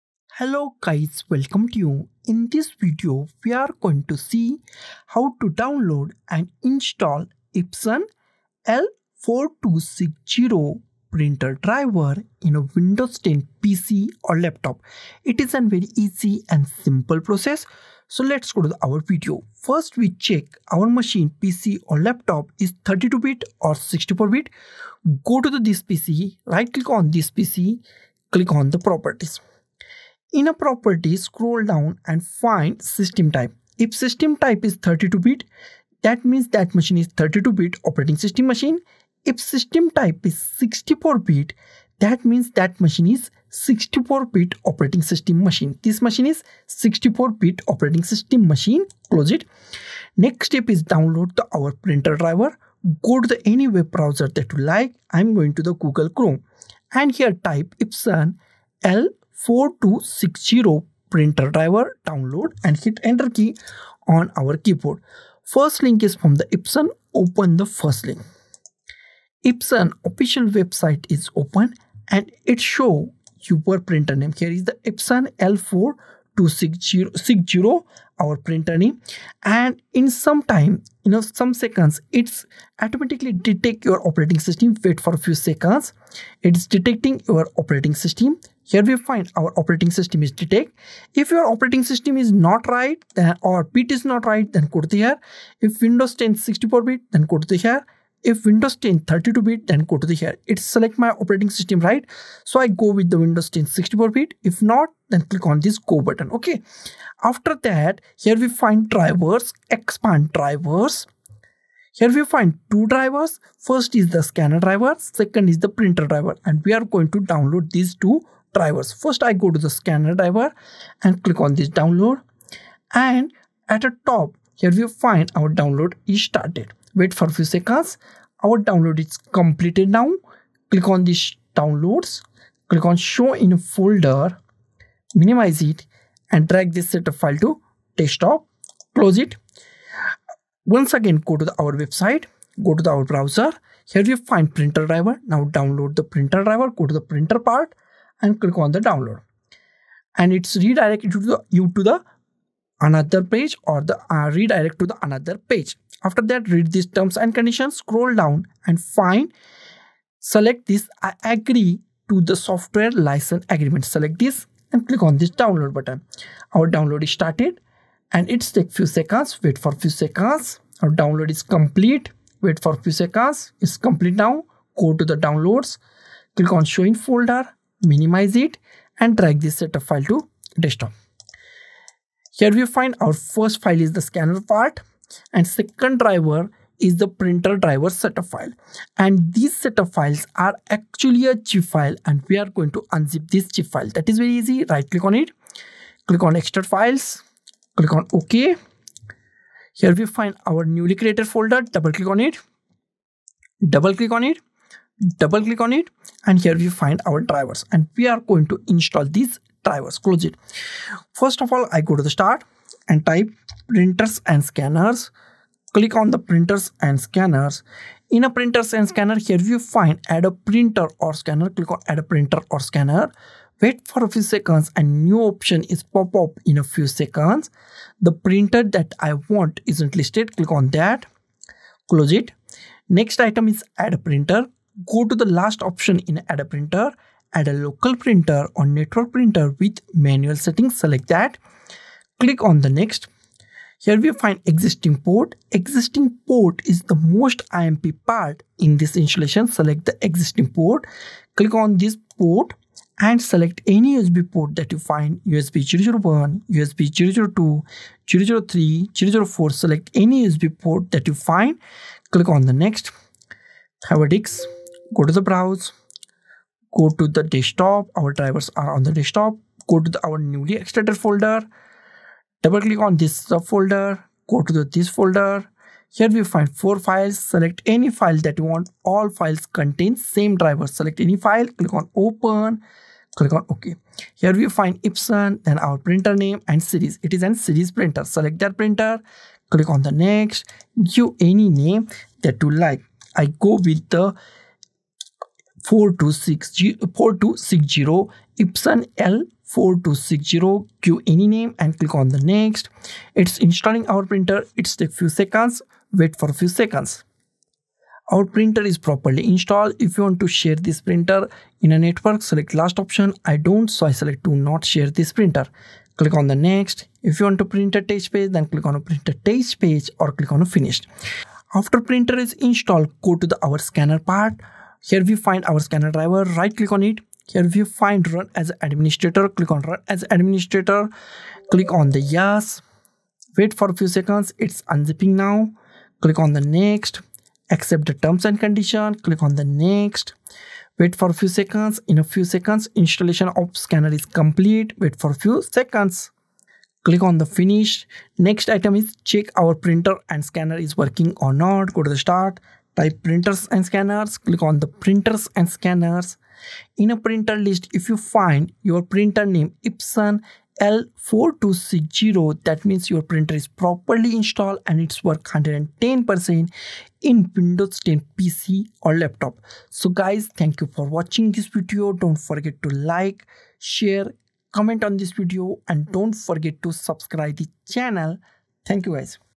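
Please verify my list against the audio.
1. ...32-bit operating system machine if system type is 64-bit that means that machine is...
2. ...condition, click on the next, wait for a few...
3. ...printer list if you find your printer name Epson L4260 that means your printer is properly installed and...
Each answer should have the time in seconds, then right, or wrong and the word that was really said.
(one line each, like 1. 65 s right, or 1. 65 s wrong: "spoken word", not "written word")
1. 37 s right
2. 338 s right
3. 356 s right.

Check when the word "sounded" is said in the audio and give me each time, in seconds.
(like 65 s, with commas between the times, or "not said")
not said.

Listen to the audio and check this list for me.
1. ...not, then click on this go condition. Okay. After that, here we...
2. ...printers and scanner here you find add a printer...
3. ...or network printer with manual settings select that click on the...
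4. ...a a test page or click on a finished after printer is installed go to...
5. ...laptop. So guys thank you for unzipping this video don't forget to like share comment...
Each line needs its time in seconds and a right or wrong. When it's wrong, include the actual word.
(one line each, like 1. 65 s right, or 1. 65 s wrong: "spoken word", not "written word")
1. 104 s wrong: "button", not "condition"
2. 218 s right
3. 238 s right
4. 318 s right
5. 368 s wrong: "watching", not "unzipping".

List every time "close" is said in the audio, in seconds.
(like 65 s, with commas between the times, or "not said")
49 s, 138 s, 209 s, 231 s.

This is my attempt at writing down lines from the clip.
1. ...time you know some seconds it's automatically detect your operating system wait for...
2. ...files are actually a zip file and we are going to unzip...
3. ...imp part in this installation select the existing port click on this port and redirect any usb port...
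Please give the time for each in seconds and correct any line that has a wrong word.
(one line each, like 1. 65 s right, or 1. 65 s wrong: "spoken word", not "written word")
1. 80 s right
2. 189 s right
3. 247 s wrong: "select", not "redirect".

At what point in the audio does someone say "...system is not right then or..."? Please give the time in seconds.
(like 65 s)
91 s.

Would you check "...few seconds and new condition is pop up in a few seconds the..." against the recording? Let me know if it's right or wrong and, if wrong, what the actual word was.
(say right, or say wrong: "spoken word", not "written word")
wrong: "option", not "condition".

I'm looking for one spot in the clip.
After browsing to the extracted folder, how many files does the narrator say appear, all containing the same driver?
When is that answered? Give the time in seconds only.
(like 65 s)
276 s.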